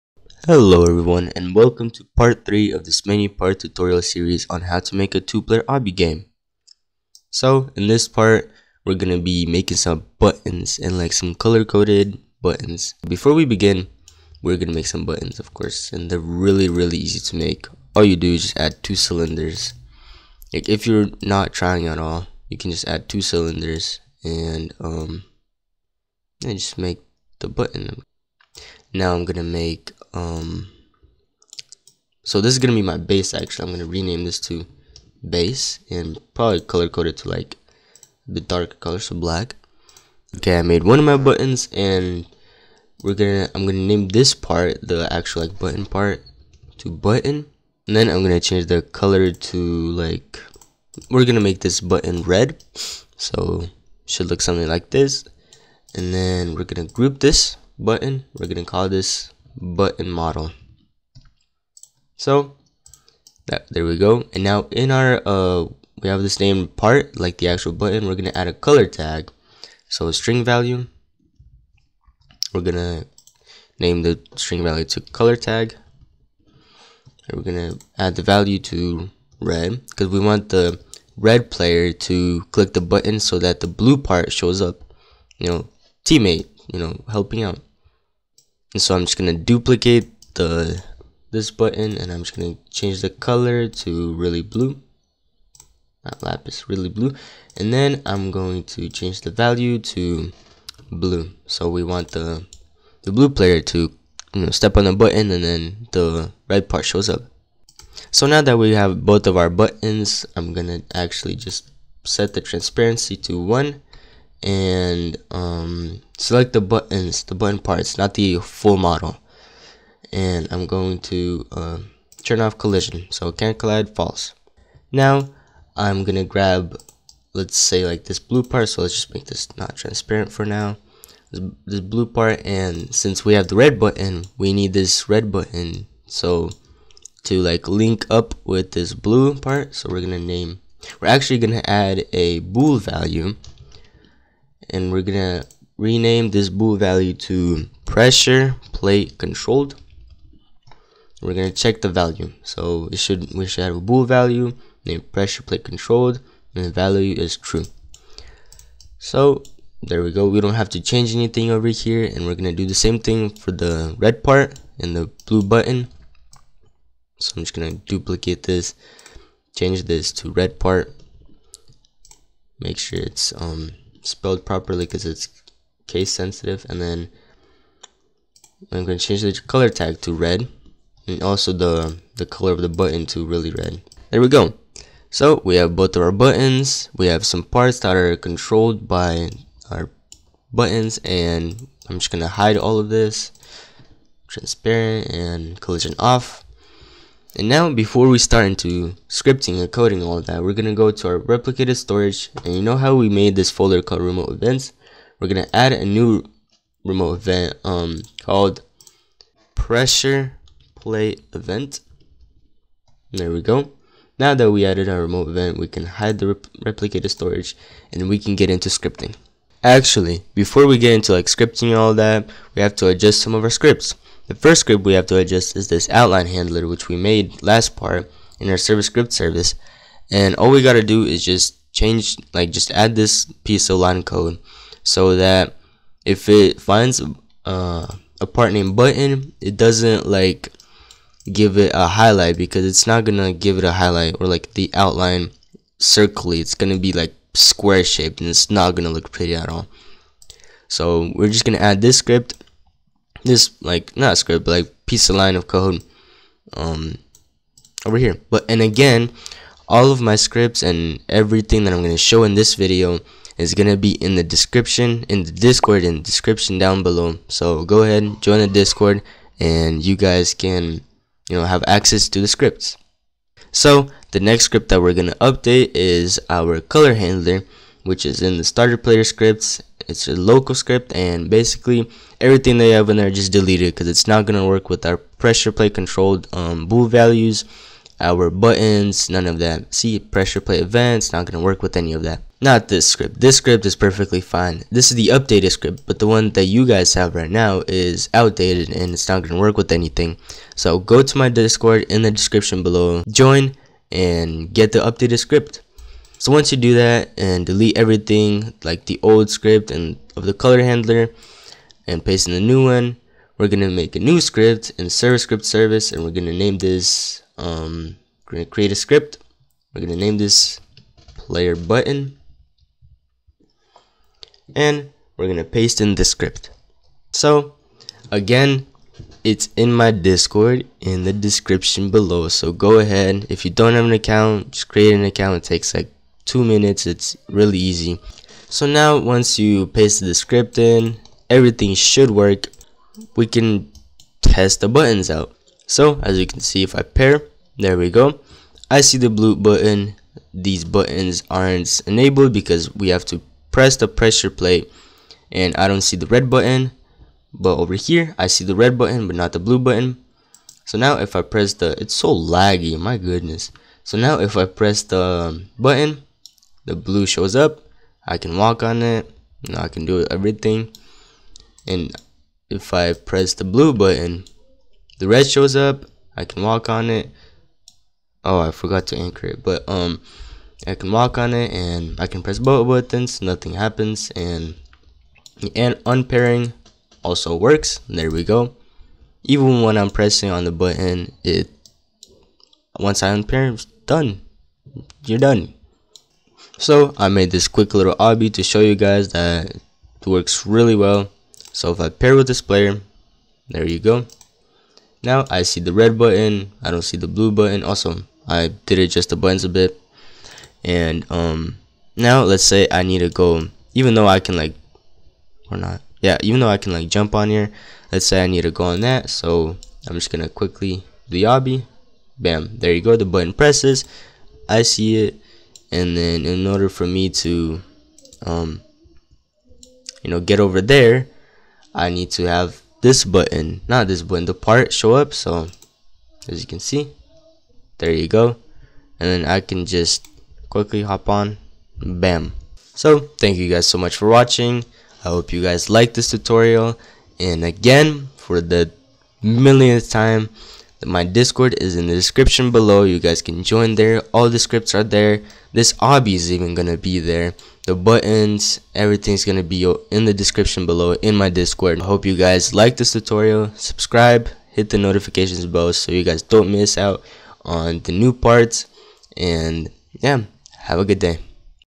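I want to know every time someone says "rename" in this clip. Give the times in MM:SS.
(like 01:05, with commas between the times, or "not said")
00:33, 02:25.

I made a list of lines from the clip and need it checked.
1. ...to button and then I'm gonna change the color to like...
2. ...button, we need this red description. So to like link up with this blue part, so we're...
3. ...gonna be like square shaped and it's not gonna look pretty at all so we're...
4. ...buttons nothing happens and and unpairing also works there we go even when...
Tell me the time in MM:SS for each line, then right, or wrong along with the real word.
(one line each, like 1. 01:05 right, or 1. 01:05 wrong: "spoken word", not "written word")
1. 00:46 right
2. 02:13 wrong: "button", not "description"
3. 04:06 right
4. 06:22 right.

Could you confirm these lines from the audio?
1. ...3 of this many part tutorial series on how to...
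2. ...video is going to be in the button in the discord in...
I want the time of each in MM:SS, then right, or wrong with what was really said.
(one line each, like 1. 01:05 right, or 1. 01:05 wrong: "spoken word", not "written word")
1. 00:02 right
2. 04:22 wrong: "description", not "button".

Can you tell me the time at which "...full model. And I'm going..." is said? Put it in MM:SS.
01:58.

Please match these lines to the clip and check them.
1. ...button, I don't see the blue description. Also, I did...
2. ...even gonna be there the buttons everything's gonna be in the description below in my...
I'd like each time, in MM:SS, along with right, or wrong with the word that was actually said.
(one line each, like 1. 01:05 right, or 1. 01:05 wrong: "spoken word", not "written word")
1. 06:45 wrong: "button", not "description"
2. 07:36 right.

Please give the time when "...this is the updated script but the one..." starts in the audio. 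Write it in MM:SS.
04:54.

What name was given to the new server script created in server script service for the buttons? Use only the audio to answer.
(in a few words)
player button.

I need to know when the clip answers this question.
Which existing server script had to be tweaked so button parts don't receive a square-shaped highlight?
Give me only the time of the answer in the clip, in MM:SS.
03:45.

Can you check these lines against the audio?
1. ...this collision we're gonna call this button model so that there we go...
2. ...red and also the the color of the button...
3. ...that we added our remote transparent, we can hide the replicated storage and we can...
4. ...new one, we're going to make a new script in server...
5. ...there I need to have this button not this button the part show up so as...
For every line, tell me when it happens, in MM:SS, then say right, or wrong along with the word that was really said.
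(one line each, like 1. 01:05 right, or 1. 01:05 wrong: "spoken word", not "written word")
1. 00:57 wrong: "button", not "collision"
2. 03:00 right
3. 03:34 wrong: "event", not "transparent"
4. 05:12 right
5. 07:10 right.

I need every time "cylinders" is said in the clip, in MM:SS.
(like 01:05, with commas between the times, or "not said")
00:18, 00:23.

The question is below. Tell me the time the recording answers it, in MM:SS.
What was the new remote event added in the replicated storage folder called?
03:29.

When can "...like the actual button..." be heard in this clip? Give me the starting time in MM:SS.
01:07.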